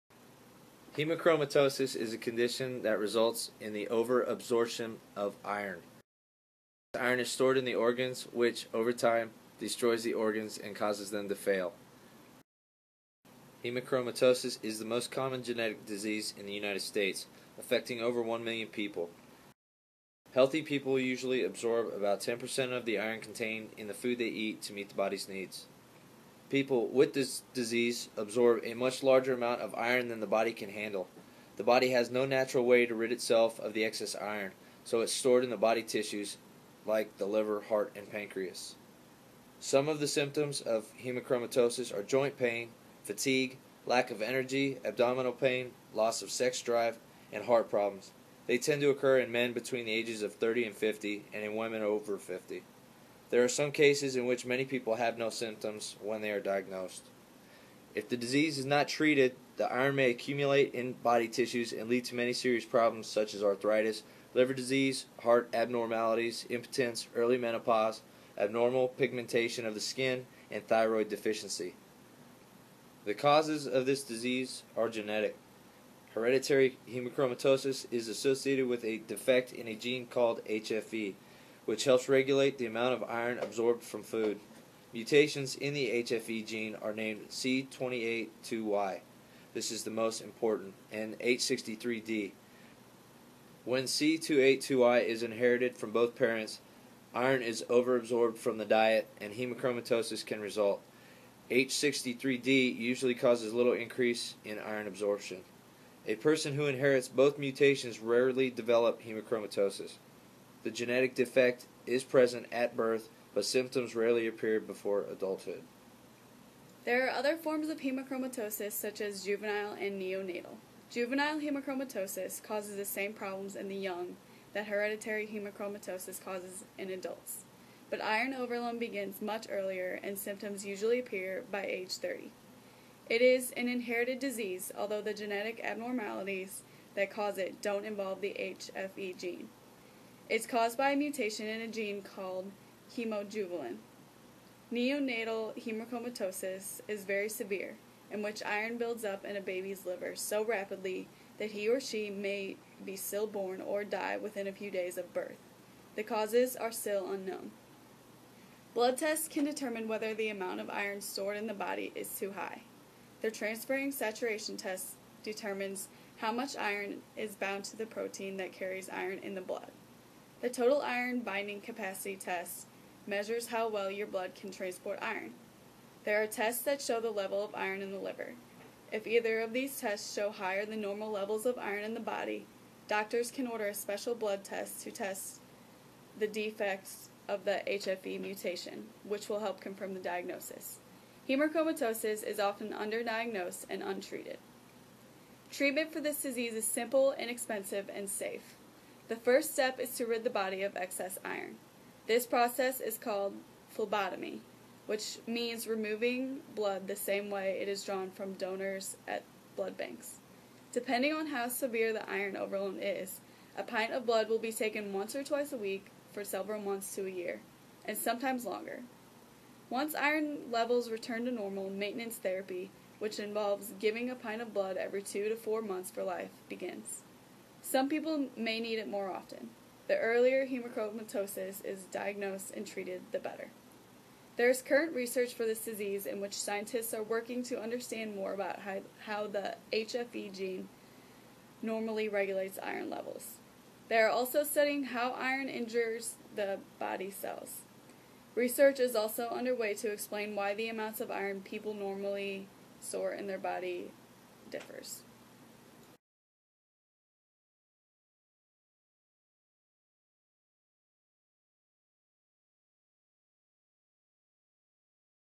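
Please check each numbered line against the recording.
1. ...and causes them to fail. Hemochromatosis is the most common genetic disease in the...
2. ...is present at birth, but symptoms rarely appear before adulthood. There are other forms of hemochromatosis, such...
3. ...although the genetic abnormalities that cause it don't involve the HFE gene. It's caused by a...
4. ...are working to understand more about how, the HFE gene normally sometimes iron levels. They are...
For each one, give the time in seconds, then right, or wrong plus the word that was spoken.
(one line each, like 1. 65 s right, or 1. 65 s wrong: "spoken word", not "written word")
1. 10 s right
2. 111 s right
3. 134 s right
4. 236 s wrong: "regulates", not "sometimes".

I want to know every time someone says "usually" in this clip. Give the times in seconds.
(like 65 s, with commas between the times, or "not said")
20 s, 102 s, 130 s.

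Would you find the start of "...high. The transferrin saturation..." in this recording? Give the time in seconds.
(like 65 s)
162 s.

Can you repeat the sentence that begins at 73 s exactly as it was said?
The causes of this disease are genetic.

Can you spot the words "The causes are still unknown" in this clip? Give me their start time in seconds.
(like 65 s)
155 s.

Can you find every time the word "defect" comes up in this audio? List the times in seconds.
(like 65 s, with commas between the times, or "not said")
78 s, 111 s, 186 s.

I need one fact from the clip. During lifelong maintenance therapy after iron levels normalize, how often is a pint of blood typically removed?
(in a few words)
every 2 to 4 months.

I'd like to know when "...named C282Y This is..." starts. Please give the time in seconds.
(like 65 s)
86 s.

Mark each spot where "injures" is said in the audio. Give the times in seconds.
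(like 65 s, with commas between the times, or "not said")
245 s.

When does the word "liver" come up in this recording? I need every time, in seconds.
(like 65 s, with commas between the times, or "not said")
37 s, 64 s, 149 s, 177 s.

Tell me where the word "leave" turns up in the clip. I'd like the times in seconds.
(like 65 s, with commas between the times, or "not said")
not said.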